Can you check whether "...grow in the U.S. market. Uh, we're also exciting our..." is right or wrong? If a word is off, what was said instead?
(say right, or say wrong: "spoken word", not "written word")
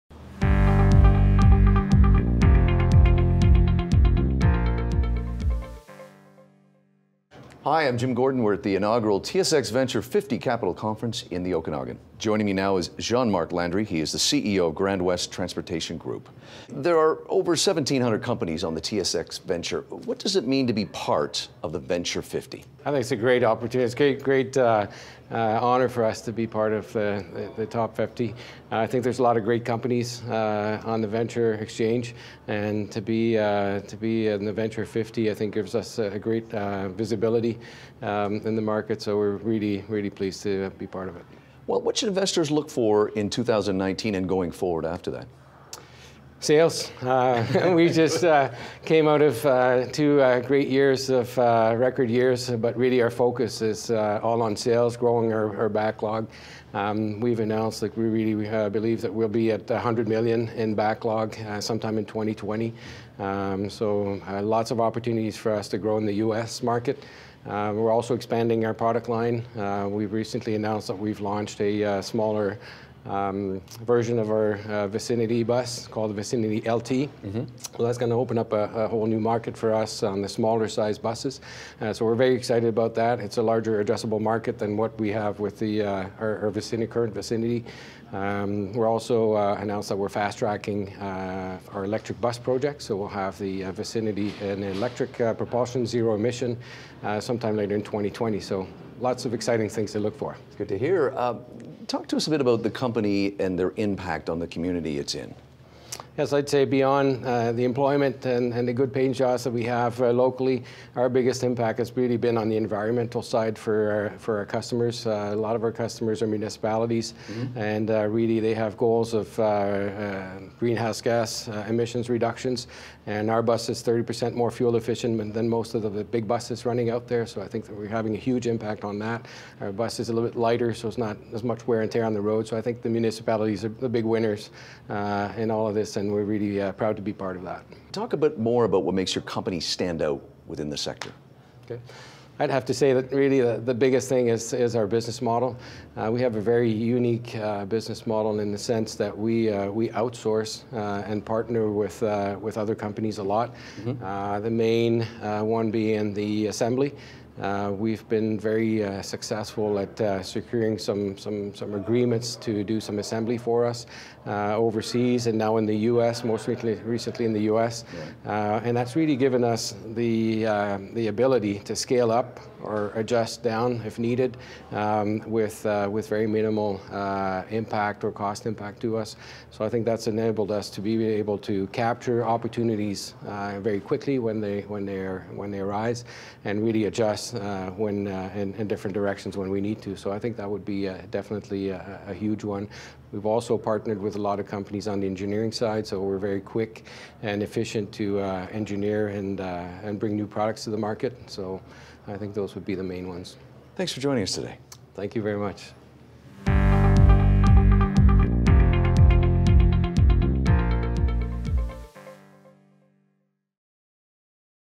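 wrong: "expanding", not "exciting".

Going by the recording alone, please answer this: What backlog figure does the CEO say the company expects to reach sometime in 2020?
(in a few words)
100 million.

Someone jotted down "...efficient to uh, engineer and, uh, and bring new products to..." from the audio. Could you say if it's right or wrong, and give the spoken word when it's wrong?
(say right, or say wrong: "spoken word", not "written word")
right.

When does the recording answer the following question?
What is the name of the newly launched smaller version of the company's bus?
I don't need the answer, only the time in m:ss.
1:16.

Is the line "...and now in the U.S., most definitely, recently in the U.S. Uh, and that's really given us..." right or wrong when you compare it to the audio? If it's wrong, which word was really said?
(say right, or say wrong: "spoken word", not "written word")
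wrong: "recently", not "definitely".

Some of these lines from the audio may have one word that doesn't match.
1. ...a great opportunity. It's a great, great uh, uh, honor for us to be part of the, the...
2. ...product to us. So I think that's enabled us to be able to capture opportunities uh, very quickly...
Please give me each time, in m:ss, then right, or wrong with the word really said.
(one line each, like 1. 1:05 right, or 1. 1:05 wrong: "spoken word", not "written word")
1. 0:23 right
2. 2:58 wrong: "impact", not "product".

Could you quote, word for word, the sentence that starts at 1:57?
and uh, really they have goals of uh, uh, greenhouse gas emissions reductions.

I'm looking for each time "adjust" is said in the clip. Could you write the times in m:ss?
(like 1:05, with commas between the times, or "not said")
2:52, 3:06.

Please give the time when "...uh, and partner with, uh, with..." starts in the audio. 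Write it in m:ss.
2:30.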